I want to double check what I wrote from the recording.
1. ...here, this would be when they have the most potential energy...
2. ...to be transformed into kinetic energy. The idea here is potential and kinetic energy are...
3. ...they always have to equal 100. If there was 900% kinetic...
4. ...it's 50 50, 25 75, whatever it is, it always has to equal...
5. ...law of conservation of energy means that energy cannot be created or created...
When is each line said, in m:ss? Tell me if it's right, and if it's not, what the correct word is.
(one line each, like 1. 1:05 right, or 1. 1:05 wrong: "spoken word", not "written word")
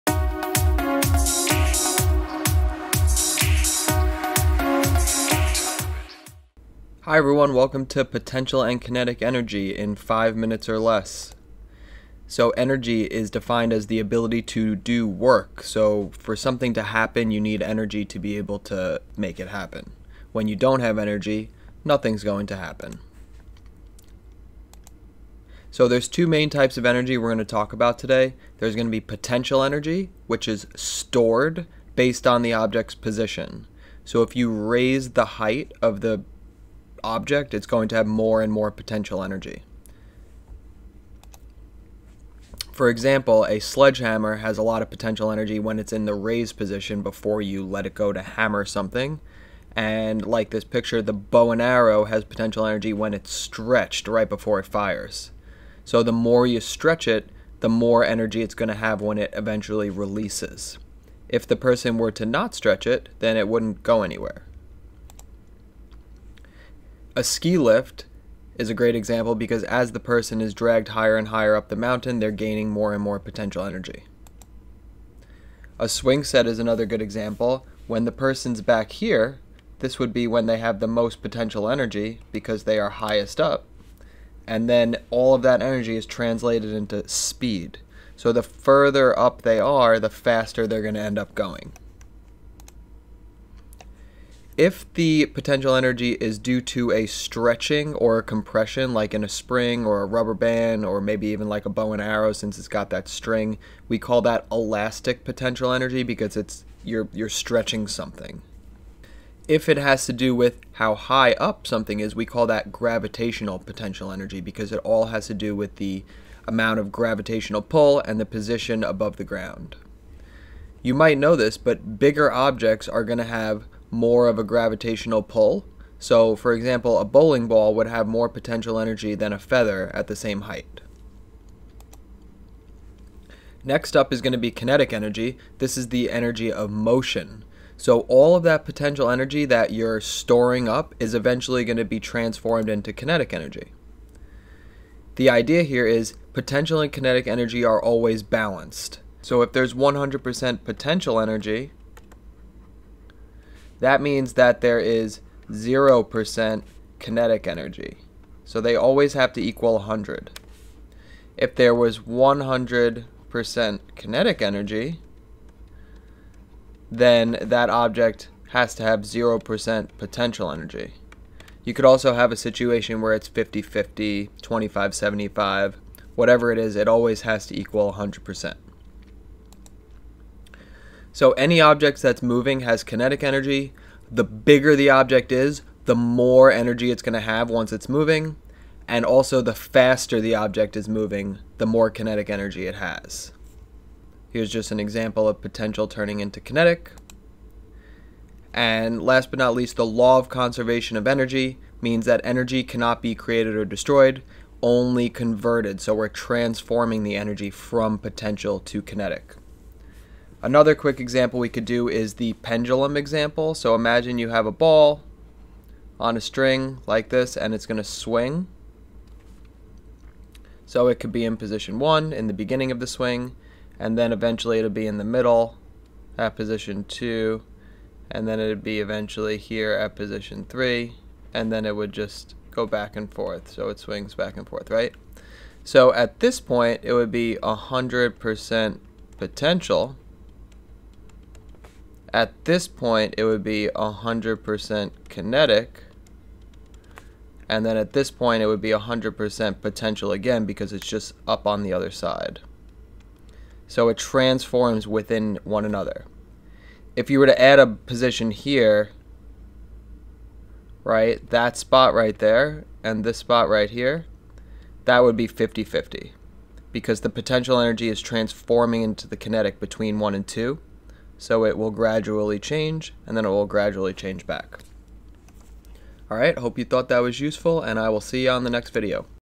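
1. 1:18 right
2. 2:21 right
3. 2:38 wrong: "100", not "900"
4. 2:53 right
5. 3:19 wrong: "destroyed", not "created".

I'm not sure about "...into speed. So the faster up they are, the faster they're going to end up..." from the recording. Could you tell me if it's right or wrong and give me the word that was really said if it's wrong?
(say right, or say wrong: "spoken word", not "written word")
wrong: "further", not "faster".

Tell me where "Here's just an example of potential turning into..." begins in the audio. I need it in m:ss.
3:14.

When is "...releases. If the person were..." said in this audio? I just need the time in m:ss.
0:59.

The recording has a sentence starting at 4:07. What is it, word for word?
And then at this point, it would be 100% potential again because it's just up on the other side.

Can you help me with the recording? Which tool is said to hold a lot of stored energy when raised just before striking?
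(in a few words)
Sledgehammer.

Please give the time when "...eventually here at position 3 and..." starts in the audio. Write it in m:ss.
3:48.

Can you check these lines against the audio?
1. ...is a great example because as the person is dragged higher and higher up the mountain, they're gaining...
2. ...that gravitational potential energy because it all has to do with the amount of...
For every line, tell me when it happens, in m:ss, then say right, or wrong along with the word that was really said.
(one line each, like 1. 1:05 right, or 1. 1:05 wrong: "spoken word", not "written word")
1. 1:08 right
2. 1:52 right.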